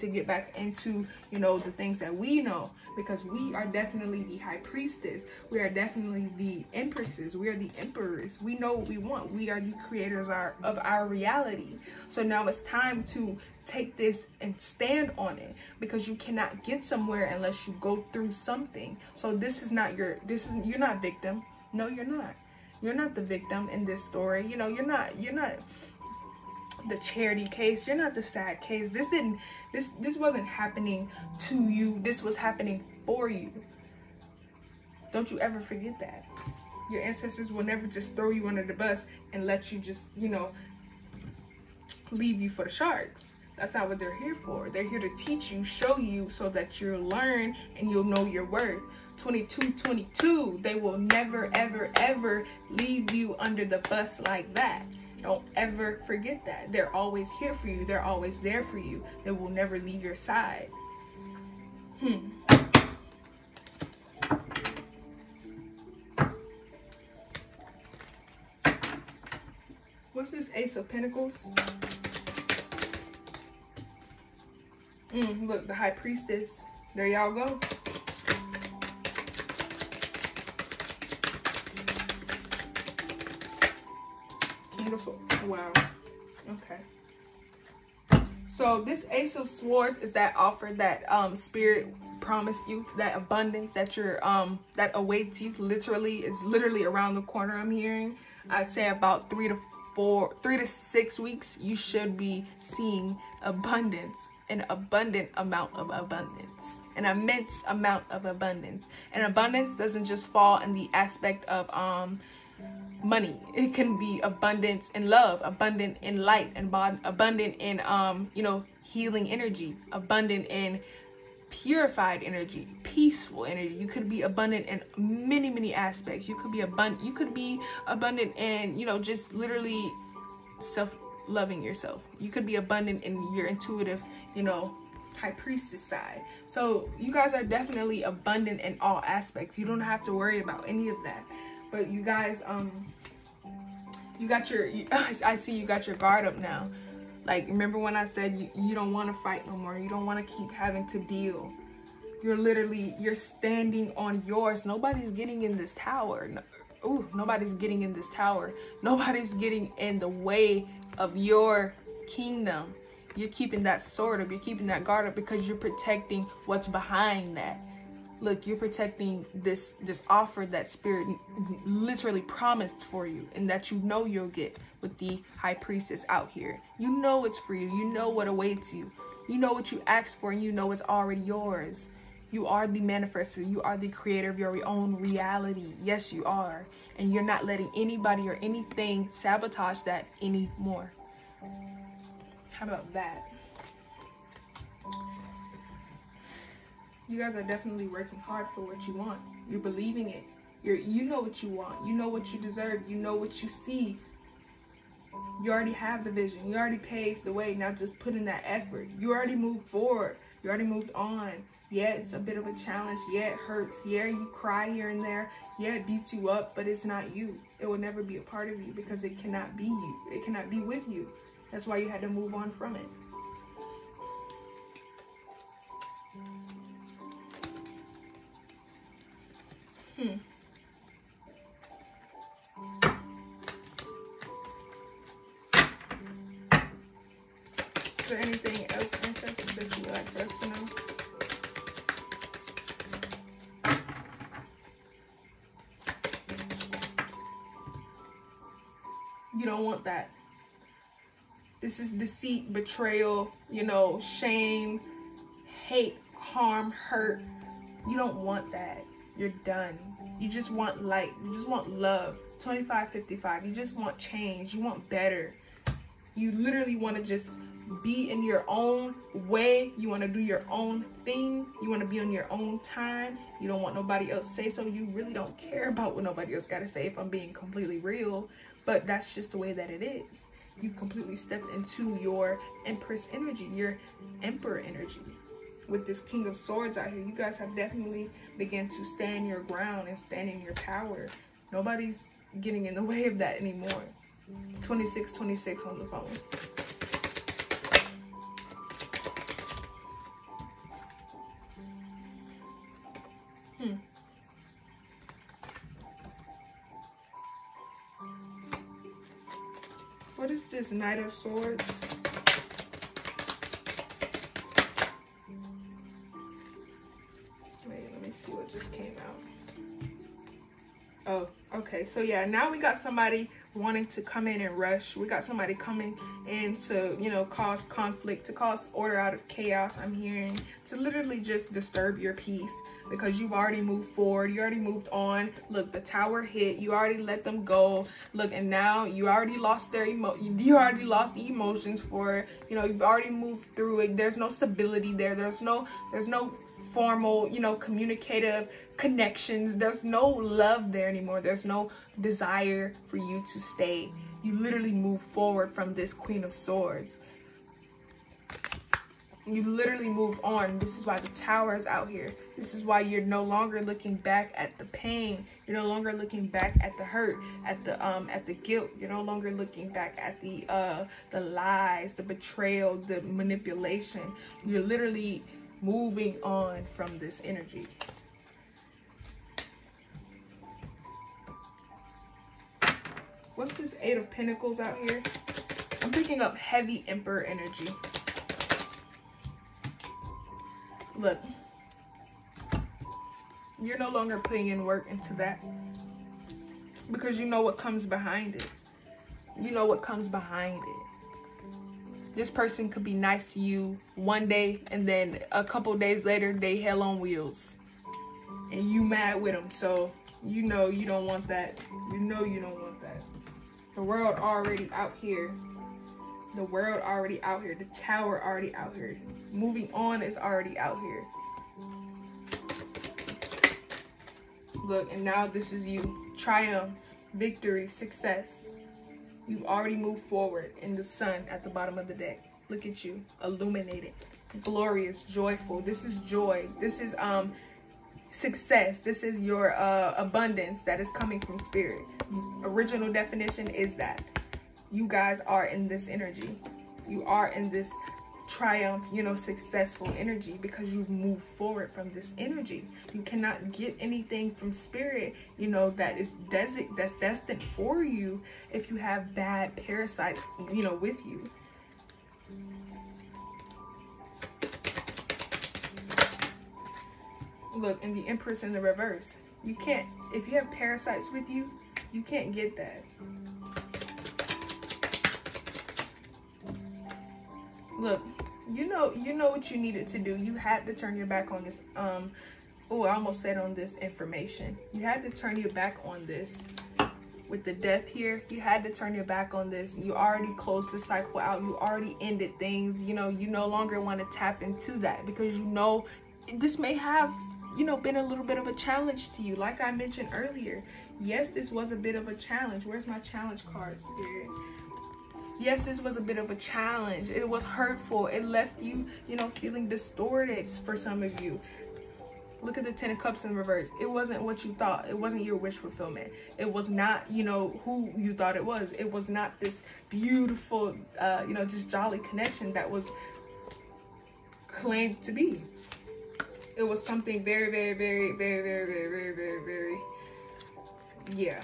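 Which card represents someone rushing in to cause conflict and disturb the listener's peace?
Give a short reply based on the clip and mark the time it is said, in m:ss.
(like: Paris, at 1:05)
Knight of Swords, at 5:10.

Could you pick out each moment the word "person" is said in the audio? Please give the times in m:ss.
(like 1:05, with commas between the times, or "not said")
6:42.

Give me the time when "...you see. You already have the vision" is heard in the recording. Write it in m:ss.
3:23.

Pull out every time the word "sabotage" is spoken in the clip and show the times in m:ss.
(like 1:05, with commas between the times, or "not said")
3:09.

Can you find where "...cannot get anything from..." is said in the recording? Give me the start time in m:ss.
7:33.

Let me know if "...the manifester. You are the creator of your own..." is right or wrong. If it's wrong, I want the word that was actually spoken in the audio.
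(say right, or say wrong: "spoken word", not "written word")
right.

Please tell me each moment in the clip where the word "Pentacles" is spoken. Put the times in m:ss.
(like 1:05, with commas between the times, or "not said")
1:10, 6:24.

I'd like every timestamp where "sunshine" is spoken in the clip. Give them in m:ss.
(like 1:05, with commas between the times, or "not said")
not said.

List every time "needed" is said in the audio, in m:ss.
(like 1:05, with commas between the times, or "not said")
7:59.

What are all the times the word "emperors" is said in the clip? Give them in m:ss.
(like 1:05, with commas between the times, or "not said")
0:07, 4:44, 6:26.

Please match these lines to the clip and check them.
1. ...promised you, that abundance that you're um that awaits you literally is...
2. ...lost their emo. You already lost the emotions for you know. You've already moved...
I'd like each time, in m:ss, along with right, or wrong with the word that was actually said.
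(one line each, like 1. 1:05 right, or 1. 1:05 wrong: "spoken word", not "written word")
1. 1:32 right
2. 5:39 right.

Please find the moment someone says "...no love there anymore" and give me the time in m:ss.
5:49.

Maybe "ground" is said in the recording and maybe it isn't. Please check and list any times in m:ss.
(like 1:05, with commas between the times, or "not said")
4:49.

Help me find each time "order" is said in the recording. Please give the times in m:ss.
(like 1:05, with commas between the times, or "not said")
5:28.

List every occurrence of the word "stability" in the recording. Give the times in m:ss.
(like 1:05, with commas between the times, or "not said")
5:44.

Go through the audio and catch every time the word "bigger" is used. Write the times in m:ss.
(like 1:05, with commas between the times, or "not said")
not said.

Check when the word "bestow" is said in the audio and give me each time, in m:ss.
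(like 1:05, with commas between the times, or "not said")
not said.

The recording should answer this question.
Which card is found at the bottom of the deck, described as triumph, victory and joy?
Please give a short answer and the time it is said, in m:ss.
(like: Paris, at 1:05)
The Sun, at 7:10.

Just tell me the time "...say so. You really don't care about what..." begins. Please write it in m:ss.
4:34.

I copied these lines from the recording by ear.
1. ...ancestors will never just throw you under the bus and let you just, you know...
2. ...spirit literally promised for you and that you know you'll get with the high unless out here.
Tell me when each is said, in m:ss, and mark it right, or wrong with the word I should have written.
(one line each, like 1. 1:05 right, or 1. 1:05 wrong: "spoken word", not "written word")
1. 0:37 right
2. 2:50 wrong: "priestess", not "unless".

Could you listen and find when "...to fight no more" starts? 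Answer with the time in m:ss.
2:29.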